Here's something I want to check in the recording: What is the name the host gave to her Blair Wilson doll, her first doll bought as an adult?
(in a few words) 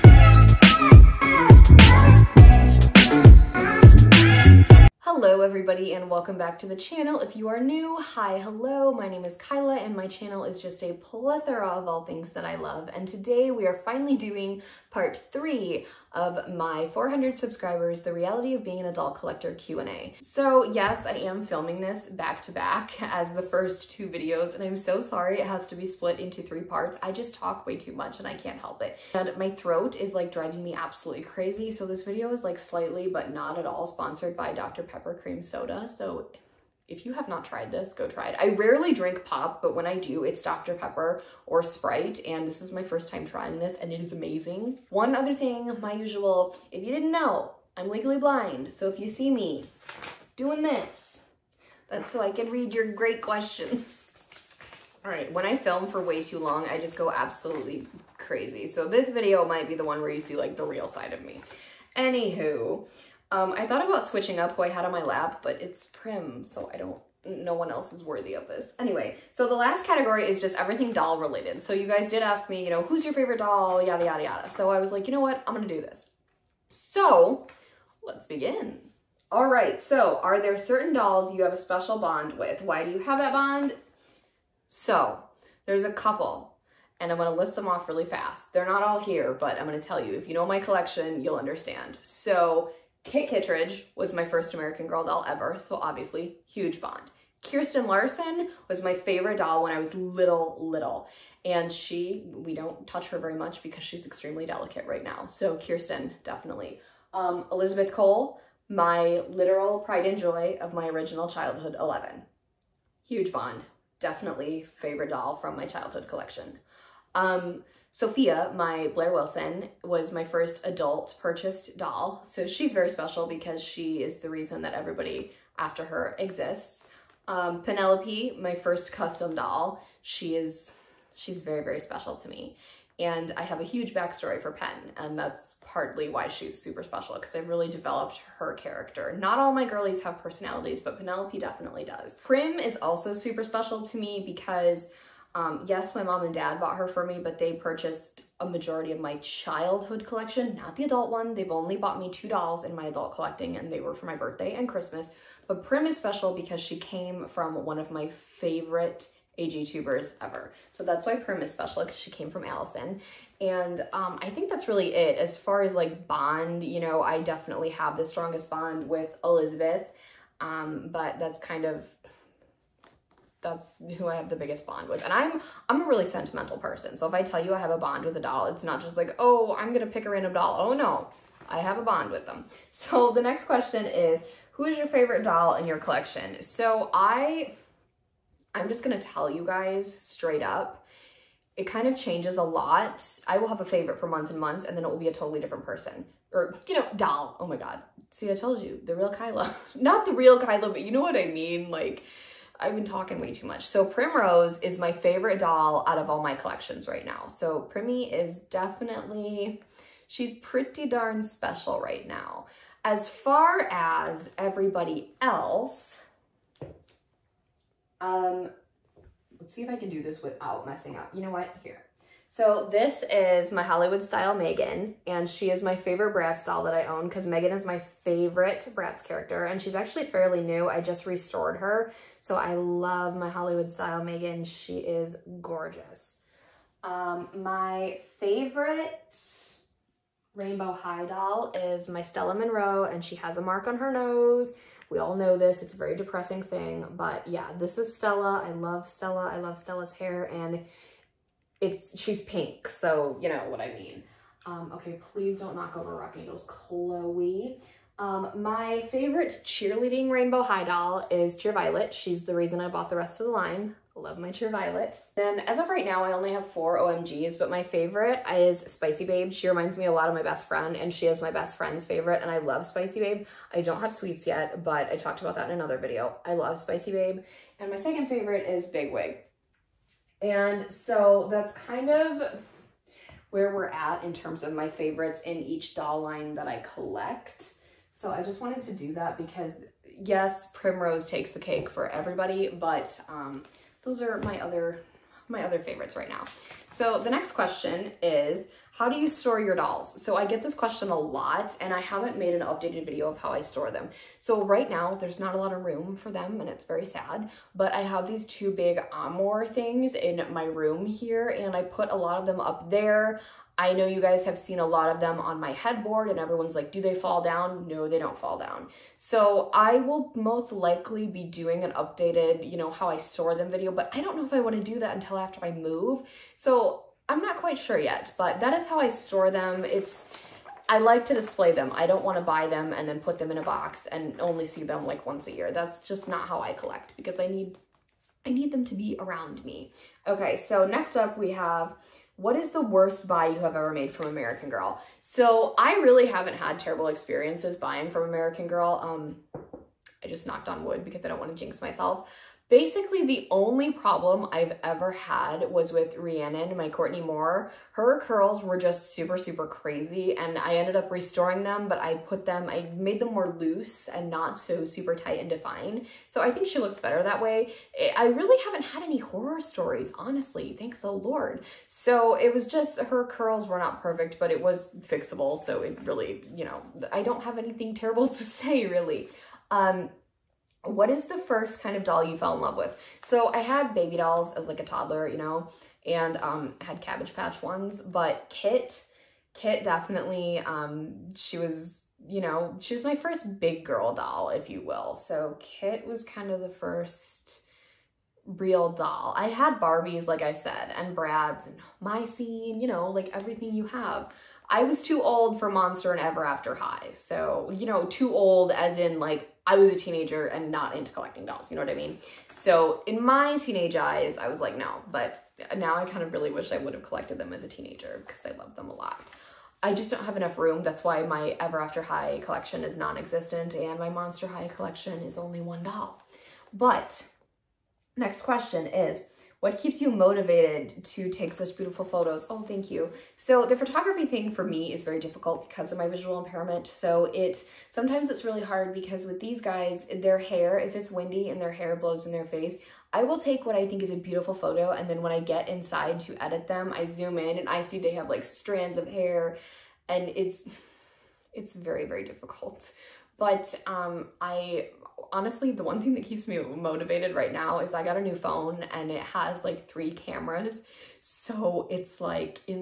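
Sophia.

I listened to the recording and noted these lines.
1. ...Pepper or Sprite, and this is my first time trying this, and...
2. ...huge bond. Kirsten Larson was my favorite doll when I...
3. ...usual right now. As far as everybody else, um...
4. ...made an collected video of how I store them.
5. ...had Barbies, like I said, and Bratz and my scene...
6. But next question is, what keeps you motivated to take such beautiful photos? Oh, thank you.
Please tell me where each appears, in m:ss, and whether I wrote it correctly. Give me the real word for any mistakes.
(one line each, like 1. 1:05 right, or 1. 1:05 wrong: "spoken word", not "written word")
1. 0:40 right
2. 1:36 right
3. 3:31 wrong: "special", not "usual"
4. 5:02 wrong: "updated", not "collected"
5. 6:39 right
6. 7:06 right.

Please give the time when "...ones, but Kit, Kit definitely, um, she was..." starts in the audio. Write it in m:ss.
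6:27.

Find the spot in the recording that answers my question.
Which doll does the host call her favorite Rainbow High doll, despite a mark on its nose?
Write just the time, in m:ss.
4:02.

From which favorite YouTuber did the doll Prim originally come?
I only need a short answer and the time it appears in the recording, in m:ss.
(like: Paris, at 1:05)
Allison, at 2:42.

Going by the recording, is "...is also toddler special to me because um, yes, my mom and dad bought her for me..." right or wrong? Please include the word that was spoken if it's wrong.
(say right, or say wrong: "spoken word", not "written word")
wrong: "super", not "toddler".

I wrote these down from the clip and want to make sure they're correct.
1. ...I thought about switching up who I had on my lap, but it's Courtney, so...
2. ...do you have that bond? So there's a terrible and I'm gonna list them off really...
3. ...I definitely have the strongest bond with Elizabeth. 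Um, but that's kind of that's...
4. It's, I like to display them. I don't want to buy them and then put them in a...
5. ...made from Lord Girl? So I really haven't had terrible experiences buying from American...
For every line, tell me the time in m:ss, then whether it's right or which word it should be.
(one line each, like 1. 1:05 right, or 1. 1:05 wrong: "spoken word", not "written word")
1. 1:03 wrong: "Prim", not "Courtney"
2. 1:22 wrong: "couple", not "terrible"
3. 2:47 right
4. 5:29 right
5. 5:43 wrong: "American", not "Lord".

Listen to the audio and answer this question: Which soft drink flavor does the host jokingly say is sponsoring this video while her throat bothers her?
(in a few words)
Dr. Pepper Cream Soda.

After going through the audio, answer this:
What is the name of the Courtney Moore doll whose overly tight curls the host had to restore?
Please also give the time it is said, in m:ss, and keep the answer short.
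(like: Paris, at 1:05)
Rhiannon, at 5:55.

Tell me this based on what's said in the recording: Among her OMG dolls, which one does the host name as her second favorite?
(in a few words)
Big Wig.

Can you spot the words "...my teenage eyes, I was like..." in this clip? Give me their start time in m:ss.
6:53.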